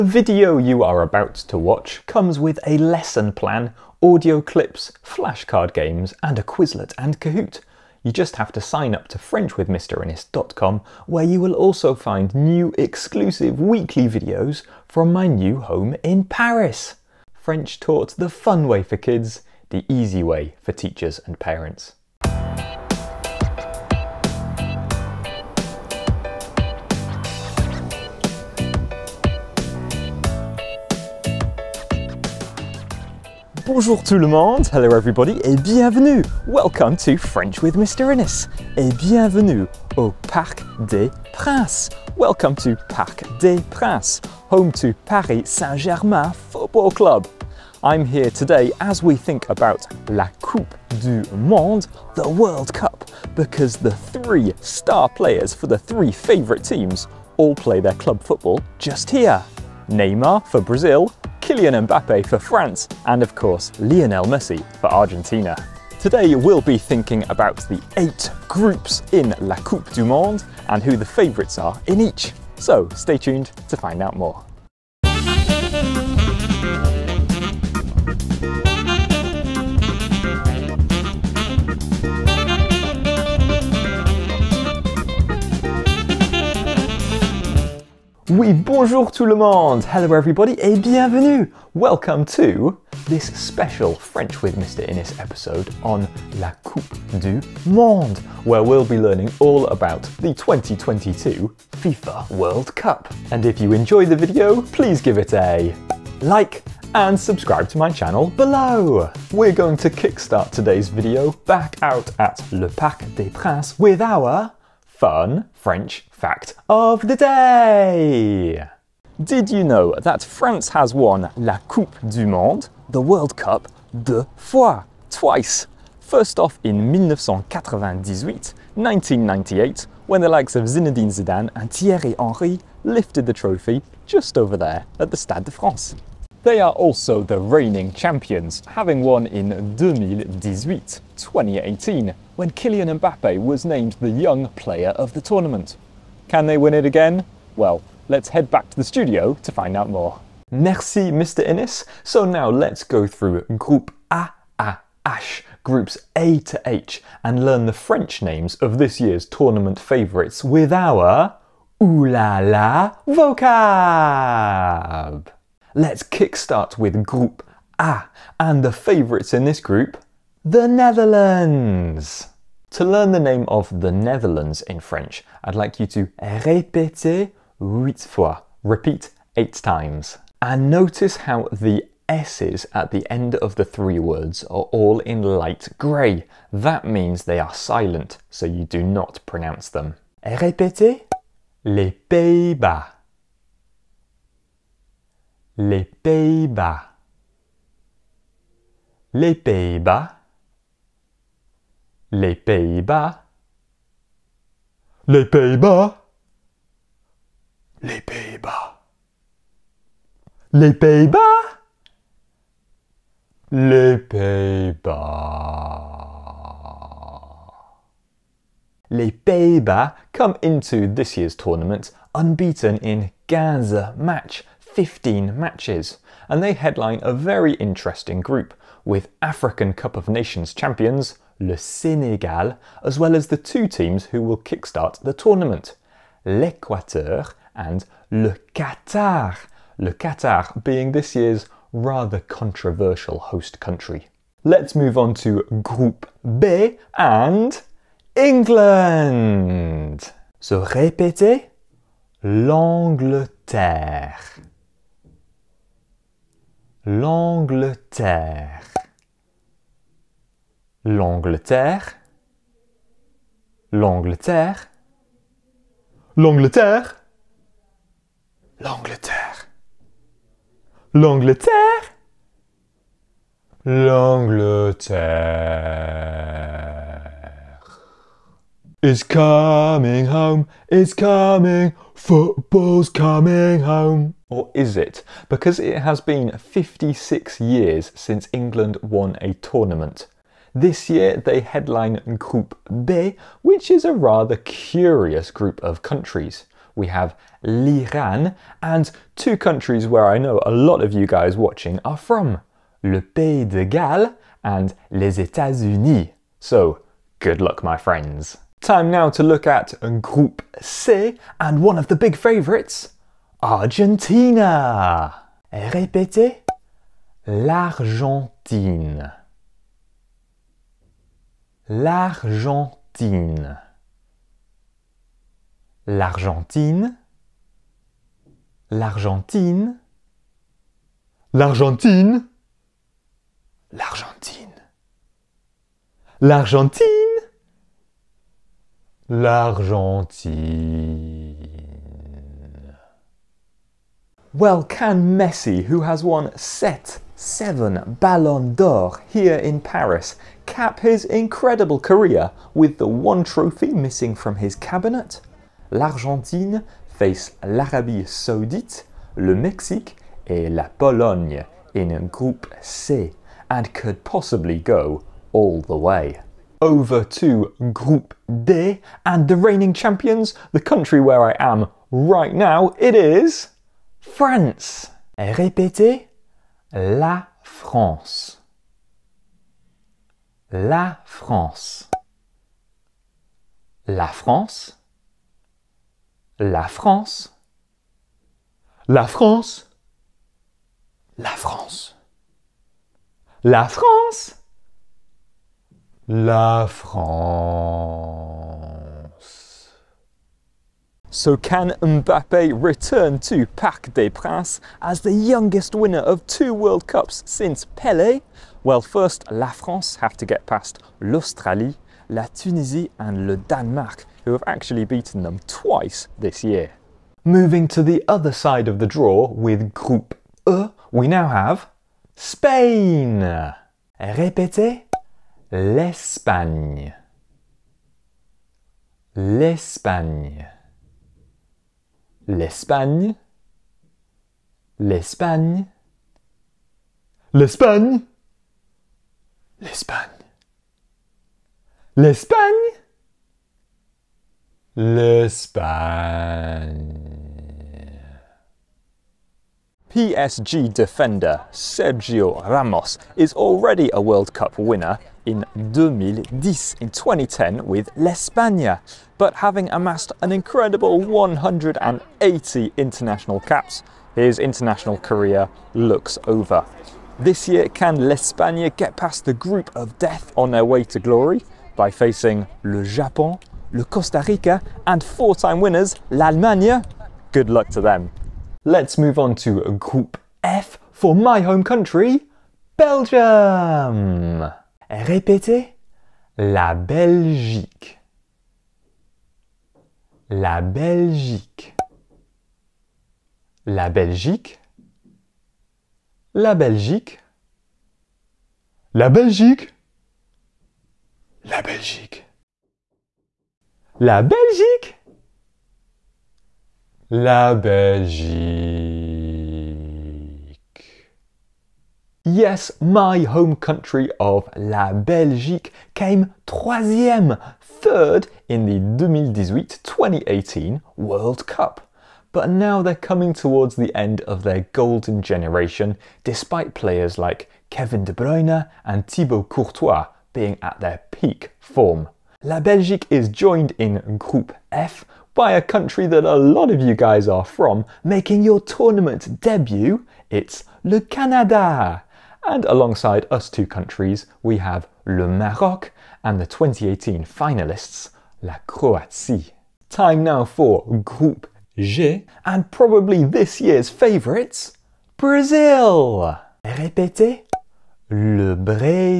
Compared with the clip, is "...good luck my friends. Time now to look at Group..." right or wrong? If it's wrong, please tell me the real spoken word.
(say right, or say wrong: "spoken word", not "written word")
right.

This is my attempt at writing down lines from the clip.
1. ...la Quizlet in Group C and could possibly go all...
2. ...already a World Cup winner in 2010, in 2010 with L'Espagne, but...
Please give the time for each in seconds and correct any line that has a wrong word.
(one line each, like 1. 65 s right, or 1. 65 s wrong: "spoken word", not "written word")
1. 360 s wrong: "Pologne", not "Quizlet"
2. 453 s right.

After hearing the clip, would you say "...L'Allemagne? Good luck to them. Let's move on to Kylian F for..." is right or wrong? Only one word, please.
wrong.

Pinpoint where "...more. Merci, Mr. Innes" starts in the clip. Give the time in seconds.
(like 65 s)
149 s.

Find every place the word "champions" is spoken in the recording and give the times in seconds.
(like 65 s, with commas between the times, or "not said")
137 s, 230 s, 369 s.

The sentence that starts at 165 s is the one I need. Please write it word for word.
Let's kickstart with Group A, and the favourites in this group, the Netherlands.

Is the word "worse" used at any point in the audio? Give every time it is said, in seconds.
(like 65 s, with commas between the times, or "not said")
not said.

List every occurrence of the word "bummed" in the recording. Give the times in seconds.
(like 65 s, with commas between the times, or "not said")
not said.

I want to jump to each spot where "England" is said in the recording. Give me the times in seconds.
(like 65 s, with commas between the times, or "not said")
248 s, 288 s.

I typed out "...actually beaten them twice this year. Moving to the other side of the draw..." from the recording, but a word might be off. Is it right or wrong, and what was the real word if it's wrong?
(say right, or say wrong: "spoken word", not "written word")
right.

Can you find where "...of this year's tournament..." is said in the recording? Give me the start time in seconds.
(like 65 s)
158 s.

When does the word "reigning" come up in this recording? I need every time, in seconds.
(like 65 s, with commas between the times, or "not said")
137 s, 369 s.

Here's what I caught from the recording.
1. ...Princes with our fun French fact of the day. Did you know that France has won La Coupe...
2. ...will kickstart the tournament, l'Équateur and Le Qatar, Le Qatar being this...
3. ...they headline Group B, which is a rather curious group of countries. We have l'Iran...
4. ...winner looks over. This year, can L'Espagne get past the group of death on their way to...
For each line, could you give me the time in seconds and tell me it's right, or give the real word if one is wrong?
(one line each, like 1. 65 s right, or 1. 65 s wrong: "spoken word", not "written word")
1. 113 s right
2. 234 s right
3. 291 s right
4. 464 s wrong: "career", not "winner".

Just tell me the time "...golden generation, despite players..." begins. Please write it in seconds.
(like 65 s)
524 s.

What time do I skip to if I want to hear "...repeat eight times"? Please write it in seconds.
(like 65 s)
178 s.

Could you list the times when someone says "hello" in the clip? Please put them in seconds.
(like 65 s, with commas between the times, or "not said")
34 s, 89 s.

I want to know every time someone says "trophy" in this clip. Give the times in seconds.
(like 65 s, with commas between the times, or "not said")
133 s, 353 s.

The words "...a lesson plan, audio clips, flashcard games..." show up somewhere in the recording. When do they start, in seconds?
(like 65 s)
2 s.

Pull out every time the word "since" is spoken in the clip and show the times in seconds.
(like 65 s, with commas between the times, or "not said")
287 s, 407 s.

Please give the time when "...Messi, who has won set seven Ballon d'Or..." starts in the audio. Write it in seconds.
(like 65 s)
345 s.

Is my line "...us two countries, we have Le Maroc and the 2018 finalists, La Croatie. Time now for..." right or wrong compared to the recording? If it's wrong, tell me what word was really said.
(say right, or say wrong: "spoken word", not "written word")
right.